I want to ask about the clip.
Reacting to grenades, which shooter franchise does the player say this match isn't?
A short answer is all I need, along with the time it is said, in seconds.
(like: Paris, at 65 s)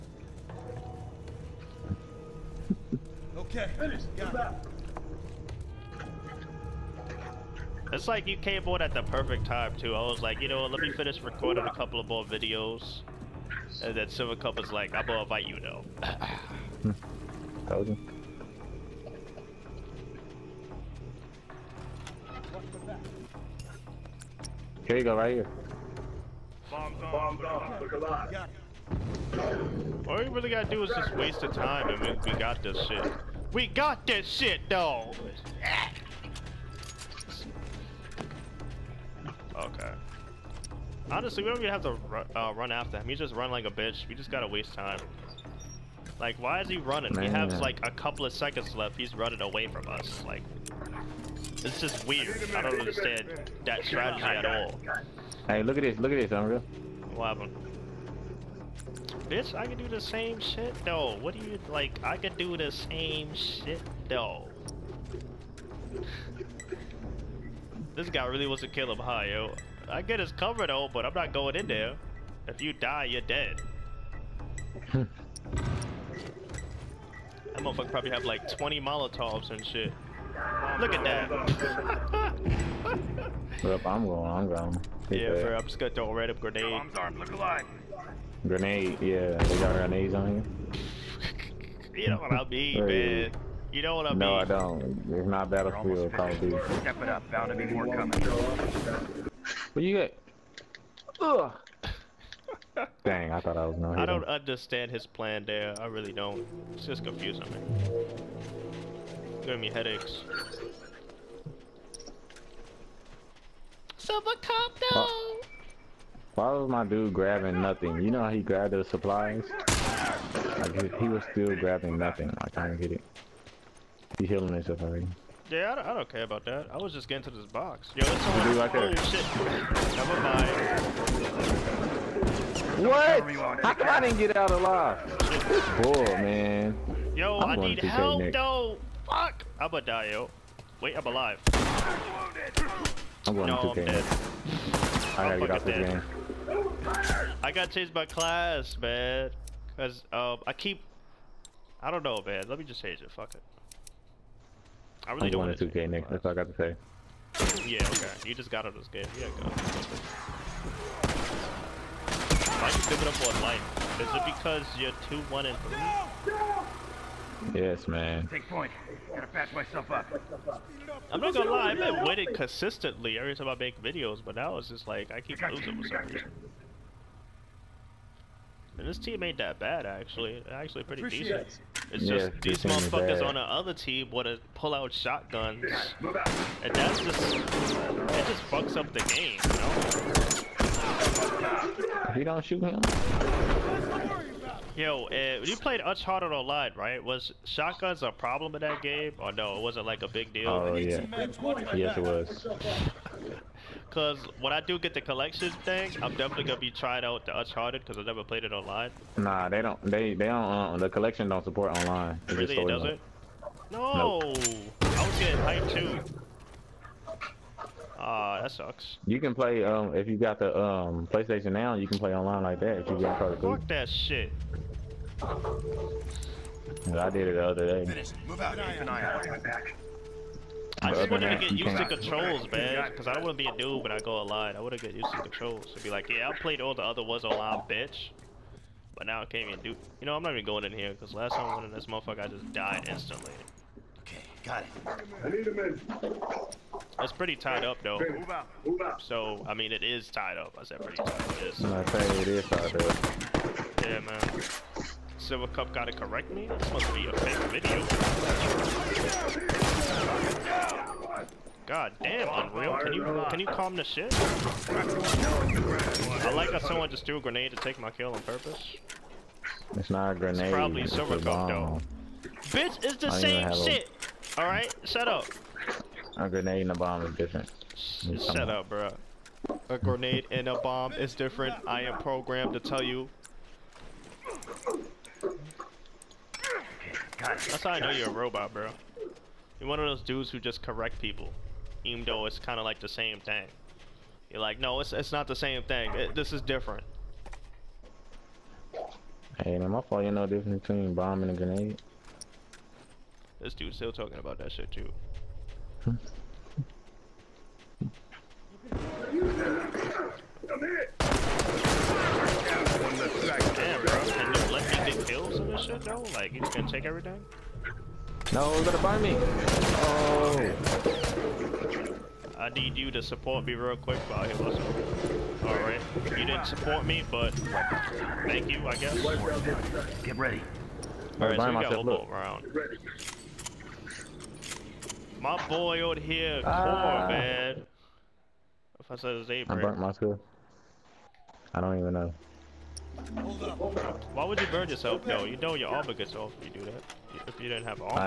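Battlefield, at 95 s.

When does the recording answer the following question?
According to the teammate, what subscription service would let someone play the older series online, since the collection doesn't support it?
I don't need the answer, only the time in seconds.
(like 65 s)
221 s.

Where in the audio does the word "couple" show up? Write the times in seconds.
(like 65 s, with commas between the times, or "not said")
11 s, 47 s.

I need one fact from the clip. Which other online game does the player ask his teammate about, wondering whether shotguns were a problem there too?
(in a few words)
Uncharted Online.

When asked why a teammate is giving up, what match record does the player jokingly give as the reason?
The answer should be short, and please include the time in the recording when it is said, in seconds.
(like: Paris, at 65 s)
2-1 and 3, at 165 s.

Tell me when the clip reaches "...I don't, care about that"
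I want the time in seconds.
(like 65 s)
125 s.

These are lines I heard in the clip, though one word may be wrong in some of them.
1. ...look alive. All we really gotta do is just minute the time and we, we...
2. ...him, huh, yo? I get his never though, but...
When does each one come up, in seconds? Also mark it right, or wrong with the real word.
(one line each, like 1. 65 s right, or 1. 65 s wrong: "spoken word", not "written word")
1. 27 s wrong: "waste", not "minute"
2. 68 s wrong: "cover", not "never".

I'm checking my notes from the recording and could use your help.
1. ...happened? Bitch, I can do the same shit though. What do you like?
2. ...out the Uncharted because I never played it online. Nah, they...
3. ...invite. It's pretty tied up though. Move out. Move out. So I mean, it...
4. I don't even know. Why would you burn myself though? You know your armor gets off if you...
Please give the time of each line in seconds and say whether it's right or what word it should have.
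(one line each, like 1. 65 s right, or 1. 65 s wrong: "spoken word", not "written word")
1. 57 s right
2. 207 s right
3. 245 s wrong: "minute", not "invite"
4. 341 s wrong: "yourself", not "myself".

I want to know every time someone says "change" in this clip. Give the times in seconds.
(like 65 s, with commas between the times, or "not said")
147 s, 152 s.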